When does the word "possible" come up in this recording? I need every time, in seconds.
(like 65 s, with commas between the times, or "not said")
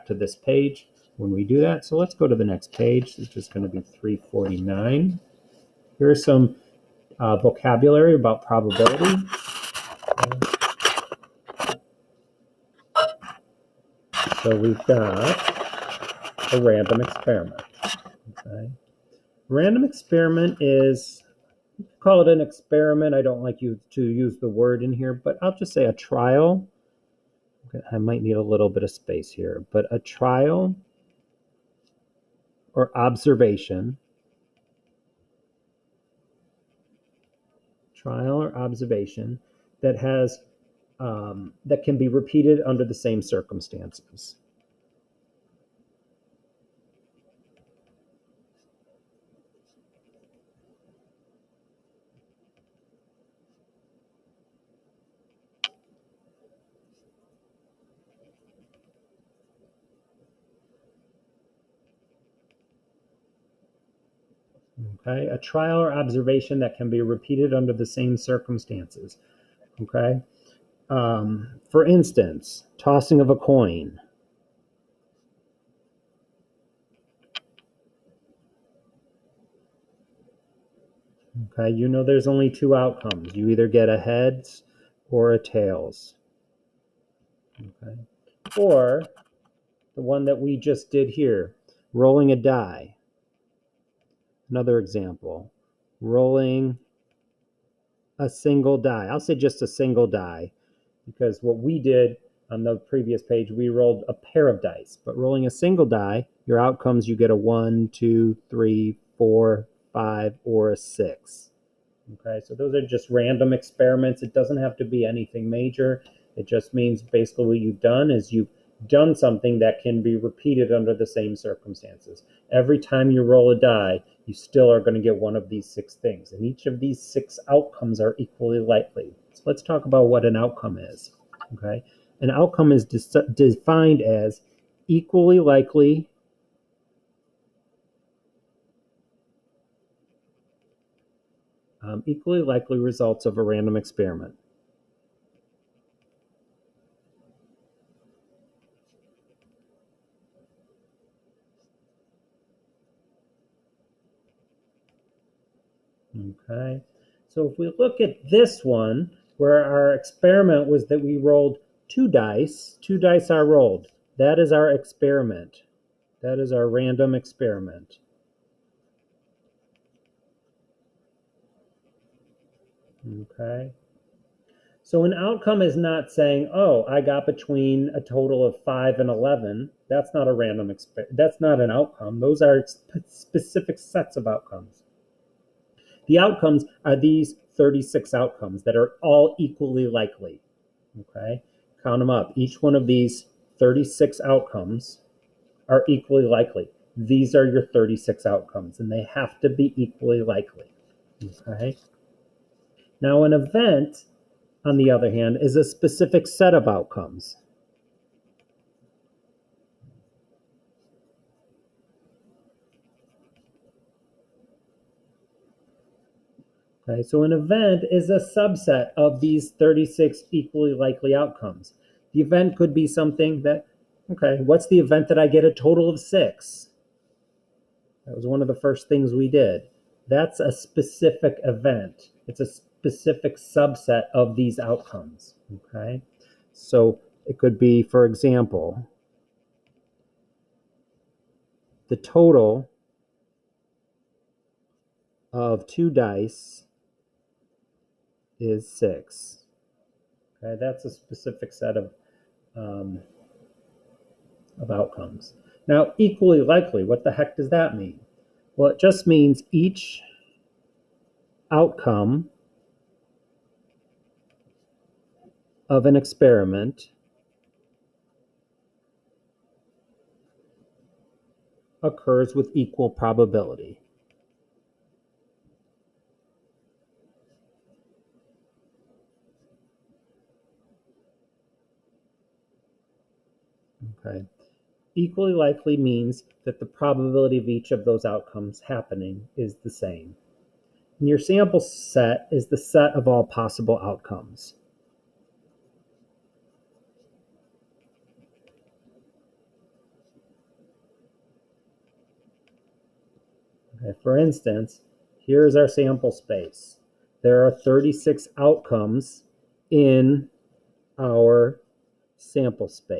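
293 s.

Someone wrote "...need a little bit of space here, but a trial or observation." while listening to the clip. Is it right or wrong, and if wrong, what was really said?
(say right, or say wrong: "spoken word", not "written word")
right.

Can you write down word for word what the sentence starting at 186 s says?
The outcomes are these 36 outcomes that are all equally likely.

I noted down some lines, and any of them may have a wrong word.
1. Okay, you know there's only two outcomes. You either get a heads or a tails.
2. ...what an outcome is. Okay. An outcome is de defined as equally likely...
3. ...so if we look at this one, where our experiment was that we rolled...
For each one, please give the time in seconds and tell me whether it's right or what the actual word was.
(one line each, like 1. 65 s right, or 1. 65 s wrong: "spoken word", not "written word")
1. 81 s right
2. 130 s right
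3. 157 s right.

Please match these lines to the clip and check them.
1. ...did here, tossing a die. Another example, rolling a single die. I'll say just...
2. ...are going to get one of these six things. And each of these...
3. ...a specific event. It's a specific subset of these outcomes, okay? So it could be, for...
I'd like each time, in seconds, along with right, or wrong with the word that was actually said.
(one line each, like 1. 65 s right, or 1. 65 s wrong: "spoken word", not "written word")
1. 90 s wrong: "rolling", not "tossing"
2. 124 s right
3. 230 s right.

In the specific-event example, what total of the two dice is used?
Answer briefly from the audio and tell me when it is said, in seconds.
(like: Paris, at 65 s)
6, at 248 s.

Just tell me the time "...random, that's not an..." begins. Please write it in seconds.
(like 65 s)
180 s.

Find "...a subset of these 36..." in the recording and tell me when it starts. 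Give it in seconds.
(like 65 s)
218 s.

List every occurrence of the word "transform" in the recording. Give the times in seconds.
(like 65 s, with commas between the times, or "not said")
not said.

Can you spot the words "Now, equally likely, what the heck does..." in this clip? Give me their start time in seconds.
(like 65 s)
255 s.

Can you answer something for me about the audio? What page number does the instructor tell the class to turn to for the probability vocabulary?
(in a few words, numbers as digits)
349.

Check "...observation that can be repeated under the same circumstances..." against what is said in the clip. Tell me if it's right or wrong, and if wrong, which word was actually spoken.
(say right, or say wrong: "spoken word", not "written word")
right.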